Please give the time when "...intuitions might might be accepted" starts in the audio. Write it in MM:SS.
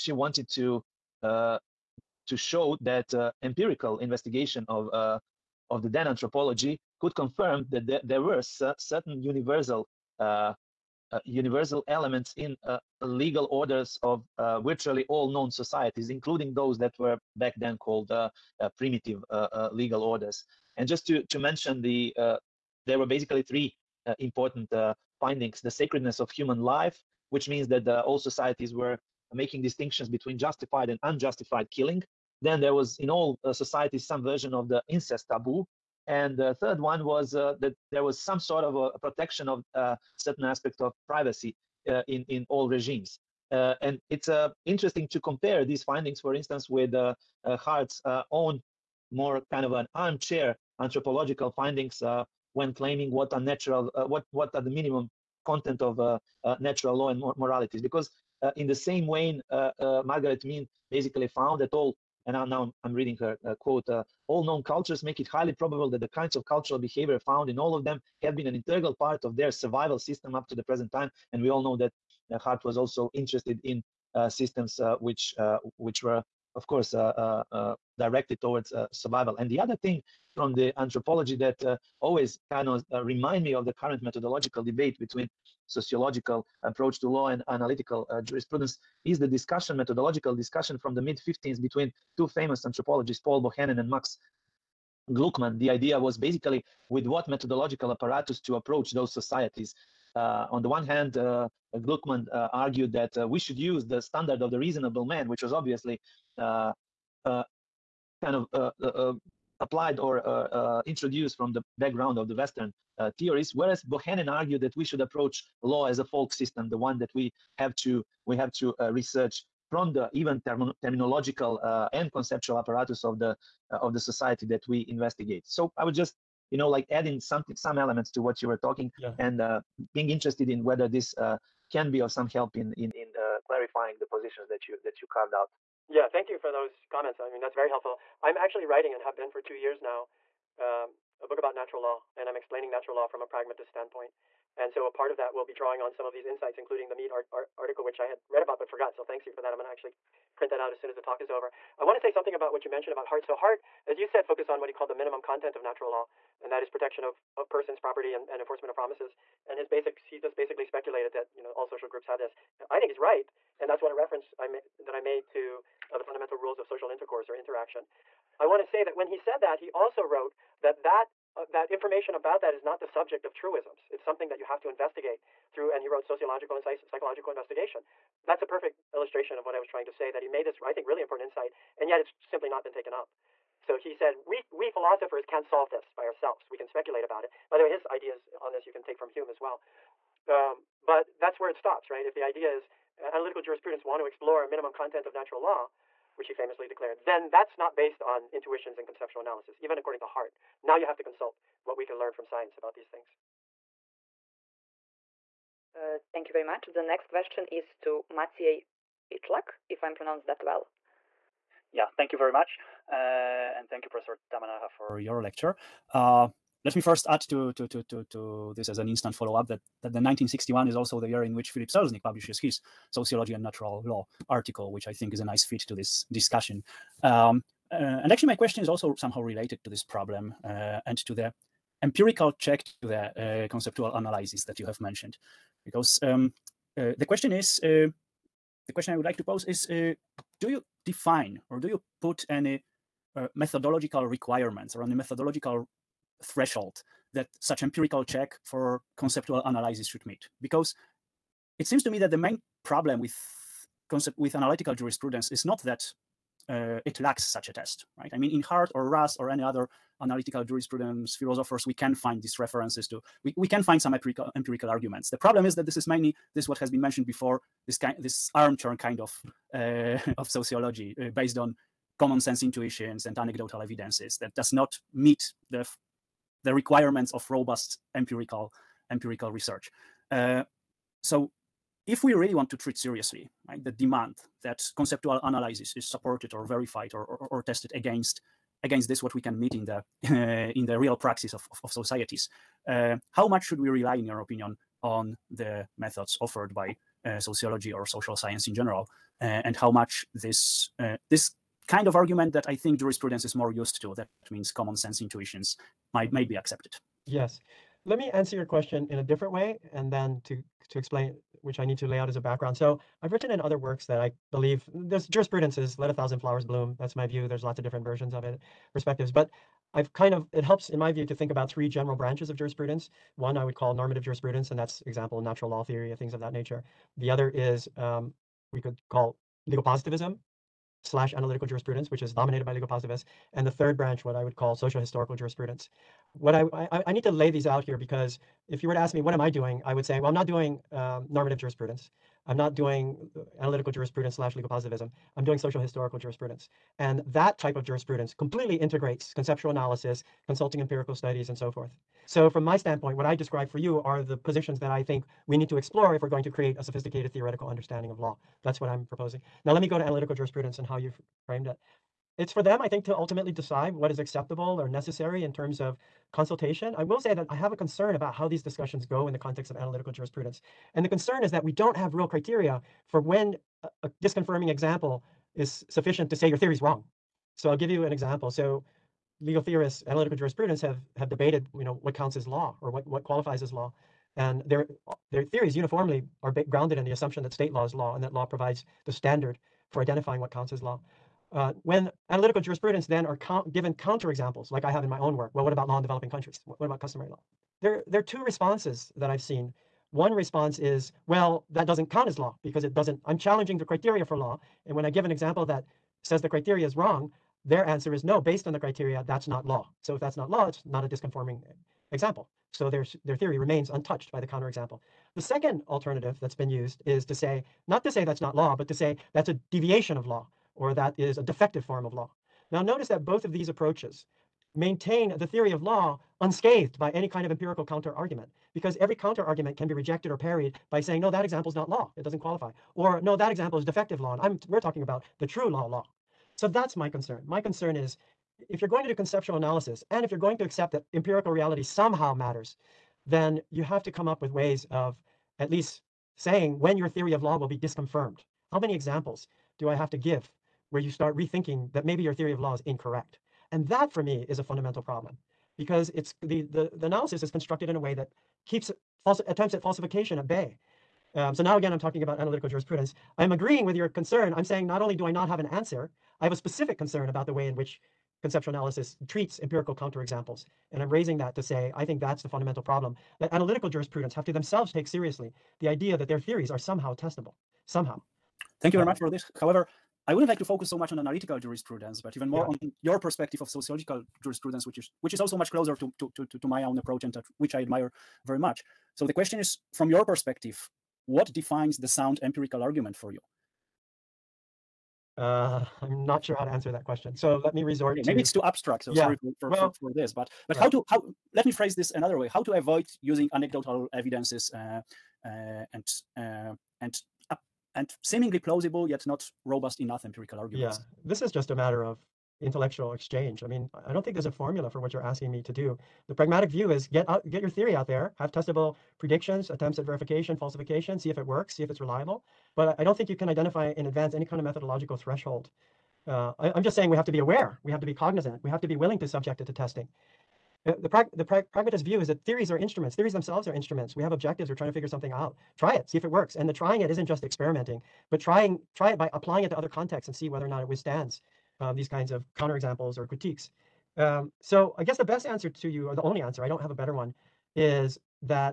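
05:05.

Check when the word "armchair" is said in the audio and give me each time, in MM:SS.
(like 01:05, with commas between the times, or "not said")
00:49, 04:28.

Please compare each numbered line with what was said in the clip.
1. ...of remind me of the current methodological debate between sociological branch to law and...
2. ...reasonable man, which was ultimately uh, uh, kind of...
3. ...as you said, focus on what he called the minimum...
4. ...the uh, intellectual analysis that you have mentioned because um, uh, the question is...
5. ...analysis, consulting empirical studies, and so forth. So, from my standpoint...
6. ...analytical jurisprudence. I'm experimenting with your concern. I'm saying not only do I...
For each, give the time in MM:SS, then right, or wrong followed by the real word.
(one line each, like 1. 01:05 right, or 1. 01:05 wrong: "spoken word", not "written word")
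1. 01:22 wrong: "approach", not "branch"
2. 01:44 wrong: "obviously", not "ultimately"
3. 02:33 right
4. 03:52 wrong: "conceptual", not "intellectual"
5. 05:49 right
6. 07:42 wrong: "agreeing", not "experimenting".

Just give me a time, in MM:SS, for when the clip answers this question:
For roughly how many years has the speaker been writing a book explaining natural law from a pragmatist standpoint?
02:19.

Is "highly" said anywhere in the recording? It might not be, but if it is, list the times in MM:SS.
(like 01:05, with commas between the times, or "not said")
01:05.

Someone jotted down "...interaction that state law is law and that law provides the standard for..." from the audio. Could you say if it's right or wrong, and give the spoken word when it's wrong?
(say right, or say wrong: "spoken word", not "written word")
wrong: "assumption", not "interaction".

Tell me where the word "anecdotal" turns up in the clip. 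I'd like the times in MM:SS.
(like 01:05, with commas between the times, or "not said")
04:33, 08:23.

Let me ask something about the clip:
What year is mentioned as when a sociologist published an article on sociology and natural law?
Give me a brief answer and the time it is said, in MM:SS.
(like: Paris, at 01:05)
1961, at 03:39.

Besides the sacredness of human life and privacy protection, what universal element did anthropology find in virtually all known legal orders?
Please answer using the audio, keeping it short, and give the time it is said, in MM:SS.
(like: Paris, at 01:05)
incest taboo, at 00:34.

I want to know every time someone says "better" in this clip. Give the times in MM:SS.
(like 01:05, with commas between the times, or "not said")
09:06.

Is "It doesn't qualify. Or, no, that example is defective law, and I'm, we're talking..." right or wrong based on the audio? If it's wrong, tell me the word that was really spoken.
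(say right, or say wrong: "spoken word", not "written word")
right.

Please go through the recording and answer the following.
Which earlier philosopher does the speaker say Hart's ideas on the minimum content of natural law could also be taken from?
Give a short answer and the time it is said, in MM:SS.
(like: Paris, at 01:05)
Hume, at 03:09.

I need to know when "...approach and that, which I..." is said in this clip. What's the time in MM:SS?
08:06.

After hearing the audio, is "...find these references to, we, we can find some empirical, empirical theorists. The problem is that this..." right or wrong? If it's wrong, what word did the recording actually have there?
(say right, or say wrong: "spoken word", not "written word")
wrong: "arguments", not "theorists".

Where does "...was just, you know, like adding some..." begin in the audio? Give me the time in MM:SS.
02:05.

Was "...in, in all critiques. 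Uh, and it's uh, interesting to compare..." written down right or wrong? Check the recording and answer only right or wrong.
wrong.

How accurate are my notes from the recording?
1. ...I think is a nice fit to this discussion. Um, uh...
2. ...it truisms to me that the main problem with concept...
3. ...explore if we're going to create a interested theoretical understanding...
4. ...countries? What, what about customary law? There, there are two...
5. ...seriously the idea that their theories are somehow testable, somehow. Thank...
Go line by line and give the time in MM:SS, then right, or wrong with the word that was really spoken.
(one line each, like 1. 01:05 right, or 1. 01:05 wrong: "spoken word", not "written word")
1. 03:44 right
2. 04:11 wrong: "seems", not "truisms"
3. 05:55 wrong: "sophisticated", not "interested"
4. 06:36 right
5. 07:54 right.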